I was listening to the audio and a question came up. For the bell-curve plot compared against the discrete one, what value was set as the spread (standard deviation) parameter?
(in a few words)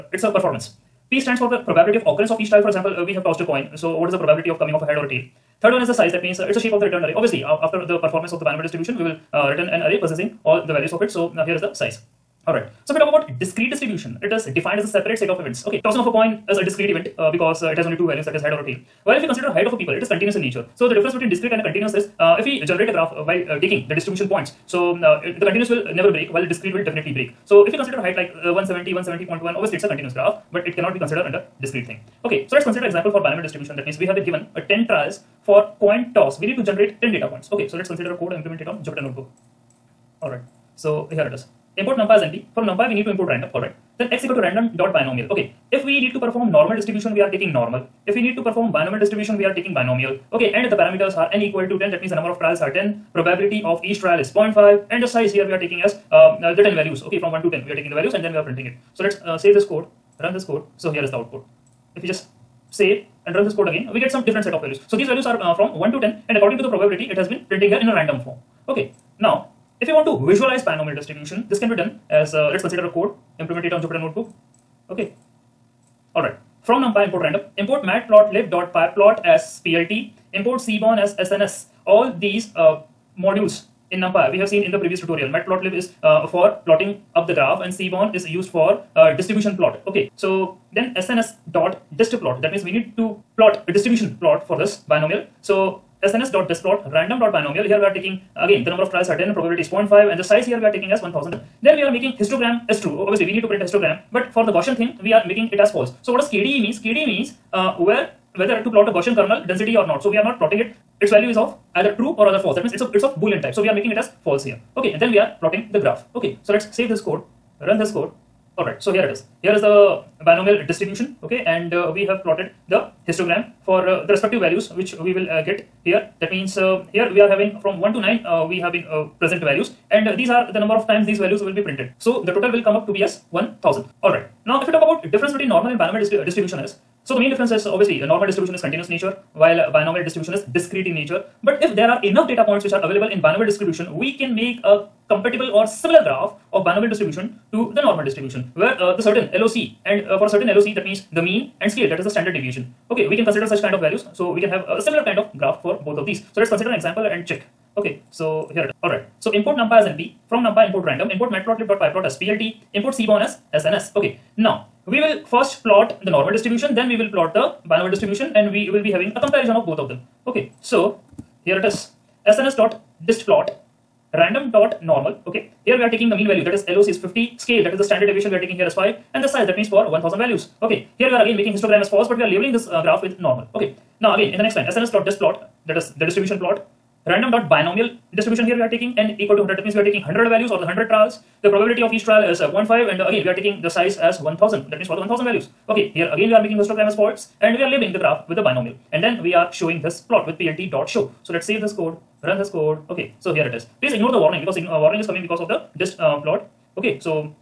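5.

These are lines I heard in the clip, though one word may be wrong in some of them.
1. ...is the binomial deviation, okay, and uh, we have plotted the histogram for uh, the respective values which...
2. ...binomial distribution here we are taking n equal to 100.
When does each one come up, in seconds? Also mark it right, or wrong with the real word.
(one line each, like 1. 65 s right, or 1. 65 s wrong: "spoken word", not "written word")
1. 119 s wrong: "distribution", not "deviation"
2. 187 s right.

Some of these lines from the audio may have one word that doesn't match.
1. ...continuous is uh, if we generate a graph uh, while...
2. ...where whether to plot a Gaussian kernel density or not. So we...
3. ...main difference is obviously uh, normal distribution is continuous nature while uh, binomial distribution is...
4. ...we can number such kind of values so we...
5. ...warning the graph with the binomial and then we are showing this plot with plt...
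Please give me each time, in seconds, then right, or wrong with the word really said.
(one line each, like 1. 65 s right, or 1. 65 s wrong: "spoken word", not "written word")
1. 21 s right
2. 107 s right
3. 137 s right
4. 153 s wrong: "consider", not "number"
5. 197 s wrong: "labeling", not "warning".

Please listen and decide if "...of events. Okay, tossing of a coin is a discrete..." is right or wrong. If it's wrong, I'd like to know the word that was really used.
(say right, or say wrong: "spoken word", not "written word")
right.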